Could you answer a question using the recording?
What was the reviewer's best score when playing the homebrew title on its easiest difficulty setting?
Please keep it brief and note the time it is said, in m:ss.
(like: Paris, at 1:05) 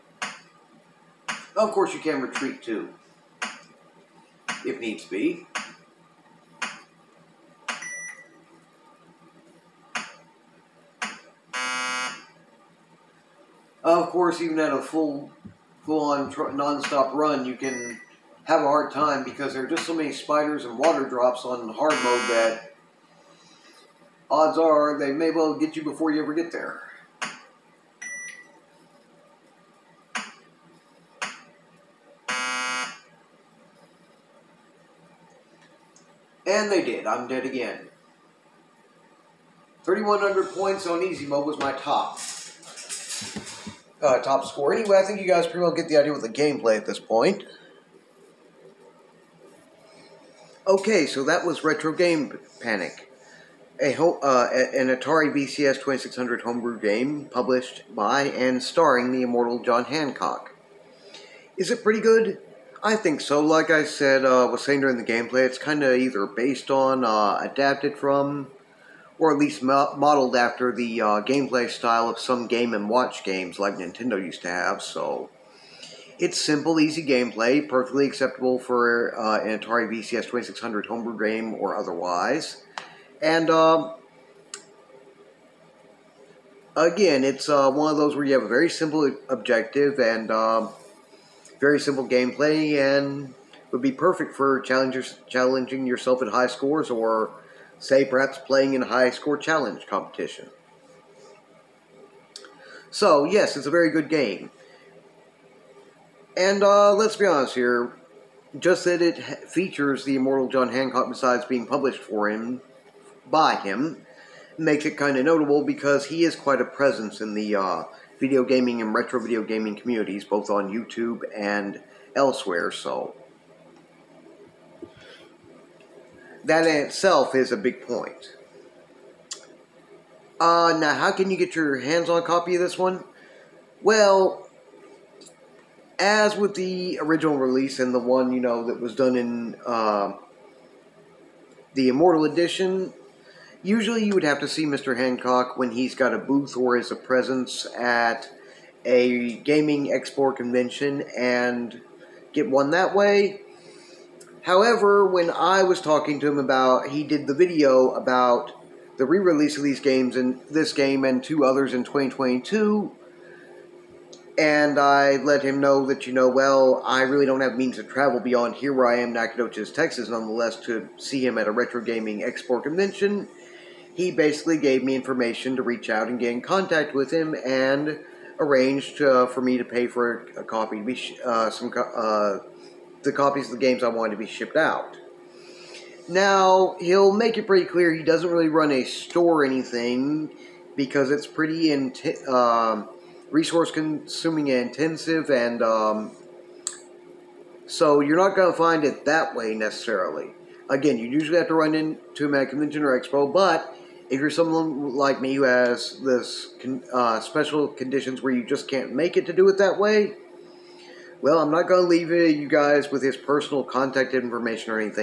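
3,100 points, at 0:39.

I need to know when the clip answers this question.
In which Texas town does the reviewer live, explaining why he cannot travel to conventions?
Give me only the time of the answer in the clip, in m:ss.
2:49.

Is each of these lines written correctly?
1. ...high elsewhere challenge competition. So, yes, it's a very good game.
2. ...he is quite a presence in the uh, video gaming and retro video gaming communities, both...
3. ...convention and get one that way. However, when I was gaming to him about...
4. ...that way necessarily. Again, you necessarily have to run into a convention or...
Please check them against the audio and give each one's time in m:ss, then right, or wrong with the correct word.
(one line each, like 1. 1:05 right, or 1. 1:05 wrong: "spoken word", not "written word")
1. 1:38 wrong: "score", not "elsewhere"
2. 1:56 right
3. 2:30 wrong: "talking", not "gaming"
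4. 3:19 wrong: "usually", not "necessarily".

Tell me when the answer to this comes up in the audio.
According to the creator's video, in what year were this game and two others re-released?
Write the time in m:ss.
2:41.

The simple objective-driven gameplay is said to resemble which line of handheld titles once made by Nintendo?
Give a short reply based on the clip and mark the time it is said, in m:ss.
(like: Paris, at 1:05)
Game and Watch, at 1:12.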